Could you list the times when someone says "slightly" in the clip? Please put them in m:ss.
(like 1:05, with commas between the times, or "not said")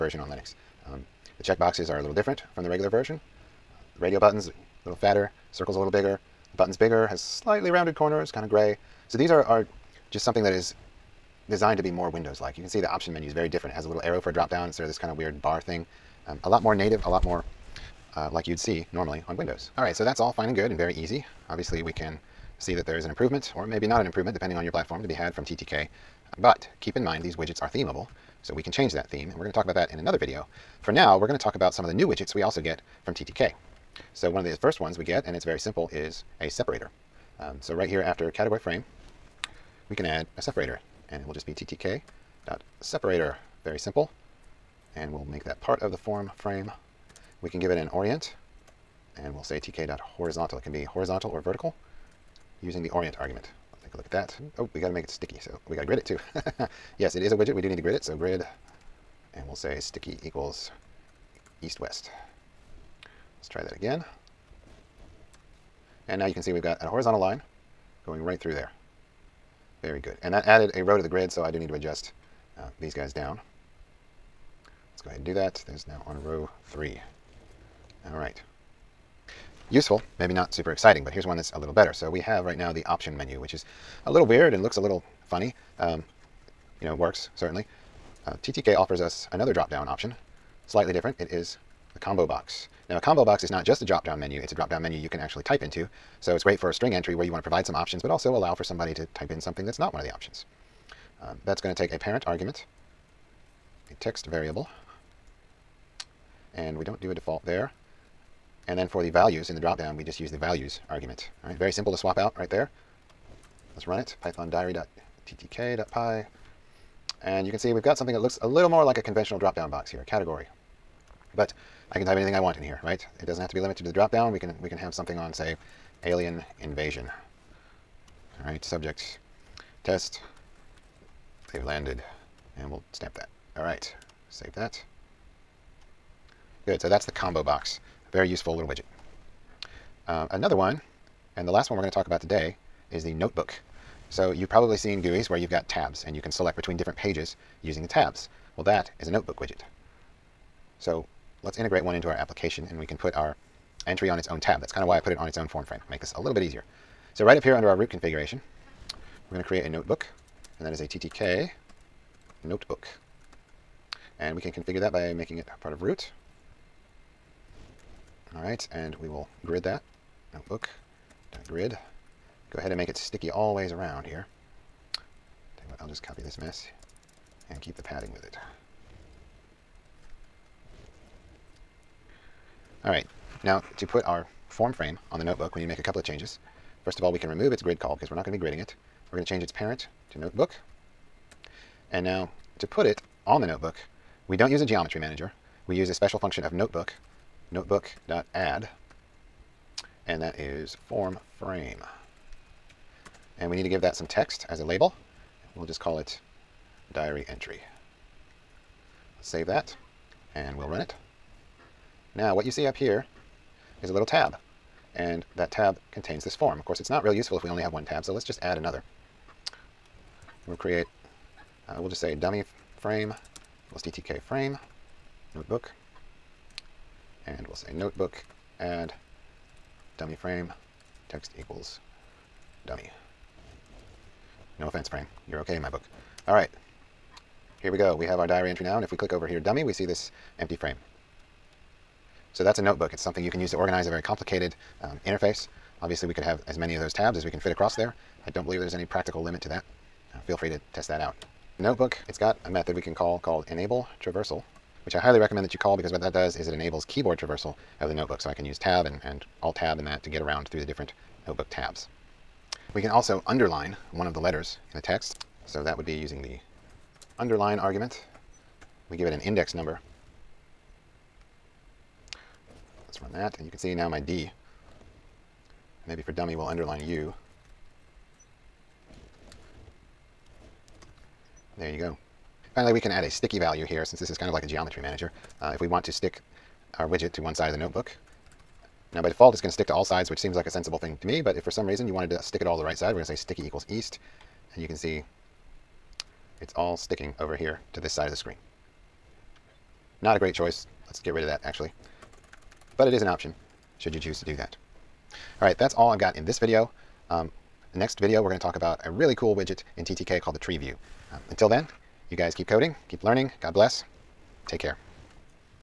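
0:07, 1:30.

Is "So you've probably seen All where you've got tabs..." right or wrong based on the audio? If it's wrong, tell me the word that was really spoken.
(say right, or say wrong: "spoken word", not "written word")
wrong: "GUIs", not "All".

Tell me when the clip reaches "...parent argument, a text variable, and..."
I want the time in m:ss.
1:41.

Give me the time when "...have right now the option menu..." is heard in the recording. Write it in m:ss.
1:22.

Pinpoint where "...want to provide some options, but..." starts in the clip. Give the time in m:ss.
1:37.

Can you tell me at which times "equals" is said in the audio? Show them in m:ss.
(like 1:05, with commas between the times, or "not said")
1:00, 3:43, 3:51, 4:53.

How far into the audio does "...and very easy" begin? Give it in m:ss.
0:20.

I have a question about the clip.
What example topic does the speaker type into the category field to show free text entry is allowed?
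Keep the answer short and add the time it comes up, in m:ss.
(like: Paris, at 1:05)
alien invasion, at 2:06.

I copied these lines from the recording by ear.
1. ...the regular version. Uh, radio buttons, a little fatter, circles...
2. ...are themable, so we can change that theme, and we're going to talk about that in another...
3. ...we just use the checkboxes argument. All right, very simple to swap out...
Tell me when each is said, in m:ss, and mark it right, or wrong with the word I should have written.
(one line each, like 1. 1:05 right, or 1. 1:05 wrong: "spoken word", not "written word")
1. 0:02 right
2. 0:27 right
3. 1:49 wrong: "values", not "checkboxes".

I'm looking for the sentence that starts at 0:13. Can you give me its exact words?
It has a little arrow for a drop-down instead of this kind of weird bar thing.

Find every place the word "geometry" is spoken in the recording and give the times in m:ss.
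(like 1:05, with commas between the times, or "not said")
3:14, 4:44.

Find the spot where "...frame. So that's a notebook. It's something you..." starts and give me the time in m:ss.
4:00.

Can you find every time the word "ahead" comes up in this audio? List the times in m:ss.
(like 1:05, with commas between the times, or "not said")
1:15, 2:52.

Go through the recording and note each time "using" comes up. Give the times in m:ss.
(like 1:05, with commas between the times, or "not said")
0:52, 2:27, 4:25.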